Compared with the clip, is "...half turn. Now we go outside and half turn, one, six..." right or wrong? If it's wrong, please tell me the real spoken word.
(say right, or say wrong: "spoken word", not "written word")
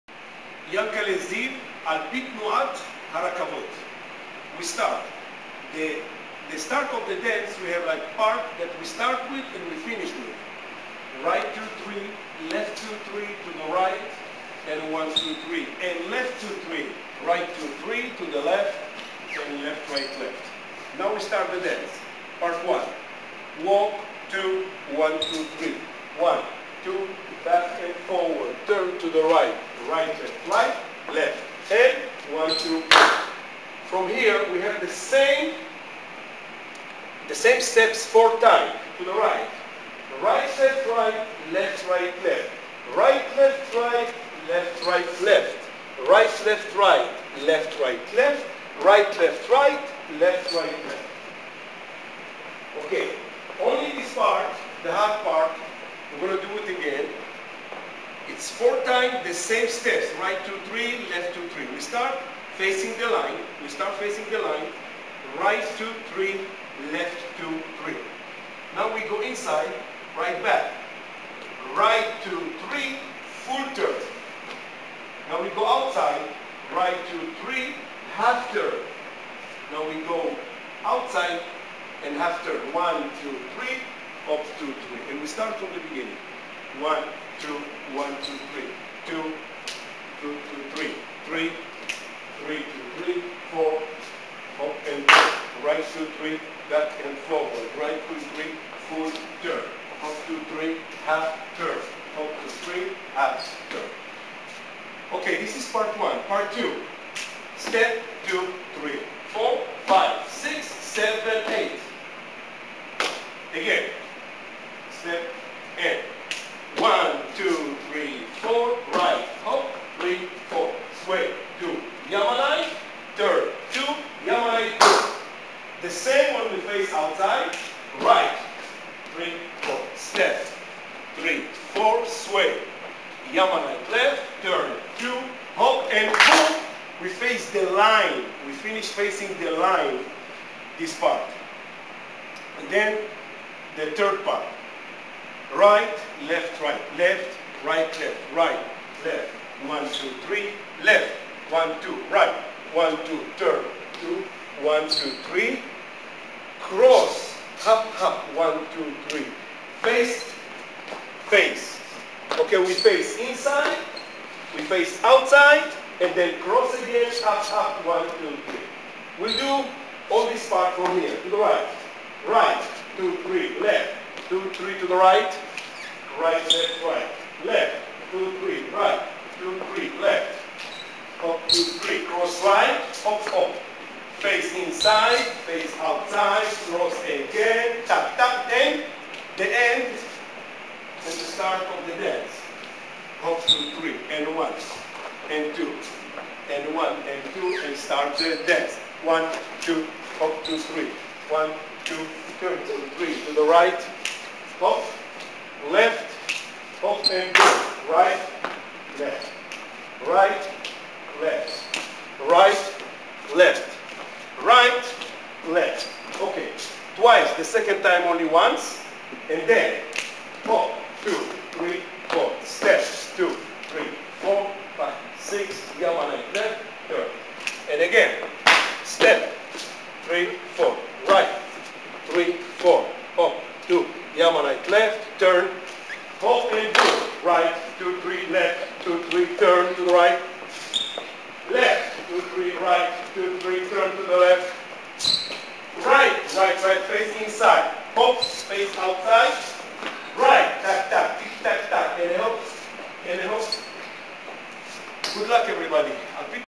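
wrong: "two", not "six".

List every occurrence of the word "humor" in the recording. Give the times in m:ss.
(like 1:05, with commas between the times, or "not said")
not said.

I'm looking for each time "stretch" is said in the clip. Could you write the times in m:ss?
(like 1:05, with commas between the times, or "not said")
not said.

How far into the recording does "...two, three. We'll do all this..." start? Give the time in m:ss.
2:48.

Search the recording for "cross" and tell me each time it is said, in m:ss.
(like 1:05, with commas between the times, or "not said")
2:36, 2:46, 3:02, 3:06.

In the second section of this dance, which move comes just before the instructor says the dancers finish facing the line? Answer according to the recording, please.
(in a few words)
Hop and pull.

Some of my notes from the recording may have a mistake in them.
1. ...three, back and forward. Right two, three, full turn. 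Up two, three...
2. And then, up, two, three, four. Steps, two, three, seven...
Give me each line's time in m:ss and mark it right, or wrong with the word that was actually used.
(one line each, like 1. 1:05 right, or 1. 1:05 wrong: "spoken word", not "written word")
1. 1:36 right
2. 3:39 wrong: "four", not "seven".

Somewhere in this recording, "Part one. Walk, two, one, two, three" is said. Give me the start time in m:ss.
0:22.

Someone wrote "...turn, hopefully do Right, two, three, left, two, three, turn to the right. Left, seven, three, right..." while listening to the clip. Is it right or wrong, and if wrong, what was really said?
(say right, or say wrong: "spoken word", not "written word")
wrong: "two", not "seven".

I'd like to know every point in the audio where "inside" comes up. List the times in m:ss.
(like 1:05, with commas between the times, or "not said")
1:09, 2:43, 3:04, 4:07.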